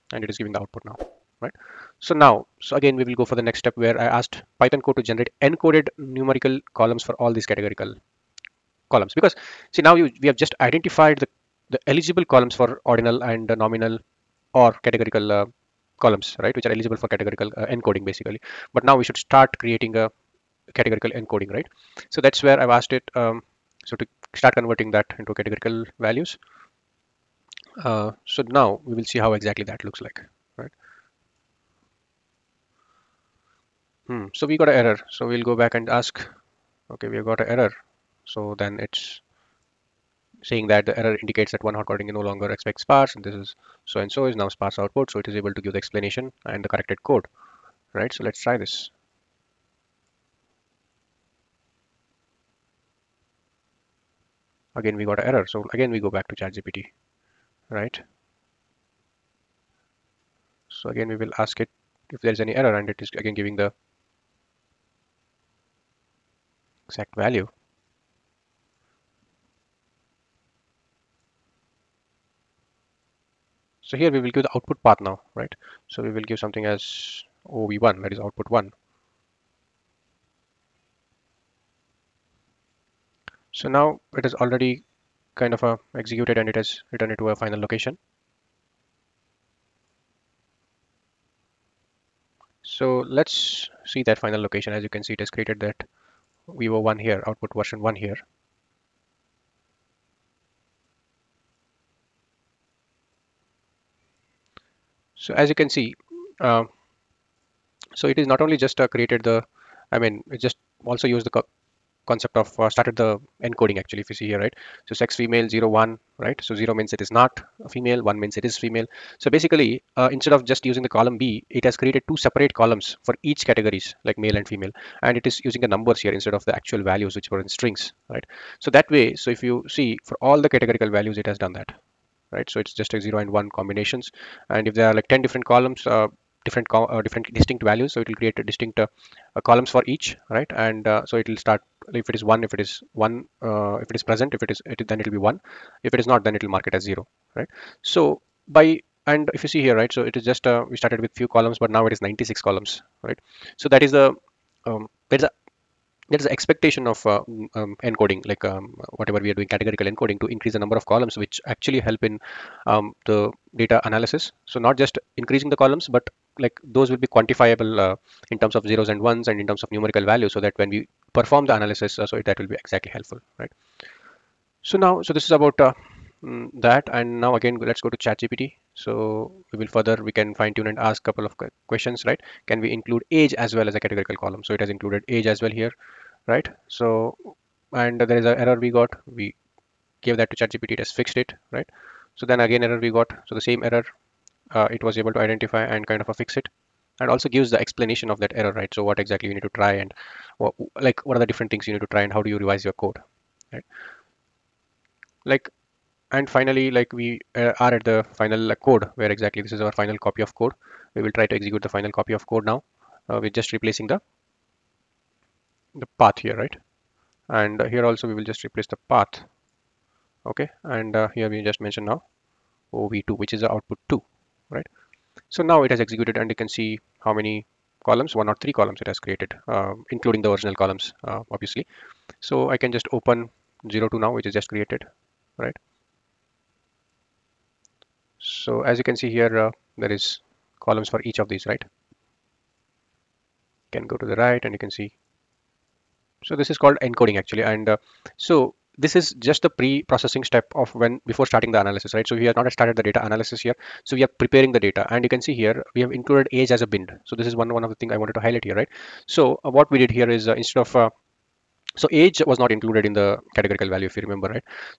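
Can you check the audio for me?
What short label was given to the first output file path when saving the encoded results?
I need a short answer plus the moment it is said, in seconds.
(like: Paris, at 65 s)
OV1, at 77 s.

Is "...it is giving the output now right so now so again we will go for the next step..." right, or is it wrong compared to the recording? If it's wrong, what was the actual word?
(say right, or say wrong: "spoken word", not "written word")
right.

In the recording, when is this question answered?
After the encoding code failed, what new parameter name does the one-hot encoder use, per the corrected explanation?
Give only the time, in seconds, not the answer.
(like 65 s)
44 s.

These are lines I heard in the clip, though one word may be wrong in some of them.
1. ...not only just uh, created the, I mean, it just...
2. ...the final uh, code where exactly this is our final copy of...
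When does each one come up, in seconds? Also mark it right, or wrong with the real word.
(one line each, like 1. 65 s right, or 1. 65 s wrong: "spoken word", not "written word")
1. 108 s right
2. 207 s right.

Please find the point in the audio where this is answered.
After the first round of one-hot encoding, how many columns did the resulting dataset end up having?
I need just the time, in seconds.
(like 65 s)
152 s.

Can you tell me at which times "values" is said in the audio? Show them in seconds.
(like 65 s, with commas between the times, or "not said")
25 s, 67 s, 126 s, 130 s, 137 s, 170 s, 263 s.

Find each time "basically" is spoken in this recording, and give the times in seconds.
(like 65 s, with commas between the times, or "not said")
18 s, 119 s.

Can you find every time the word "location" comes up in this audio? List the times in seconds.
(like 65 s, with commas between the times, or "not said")
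87 s, 94 s.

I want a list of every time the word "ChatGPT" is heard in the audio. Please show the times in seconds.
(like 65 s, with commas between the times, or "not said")
56 s, 177 s, 190 s.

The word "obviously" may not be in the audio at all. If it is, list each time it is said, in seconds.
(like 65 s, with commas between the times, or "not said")
231 s.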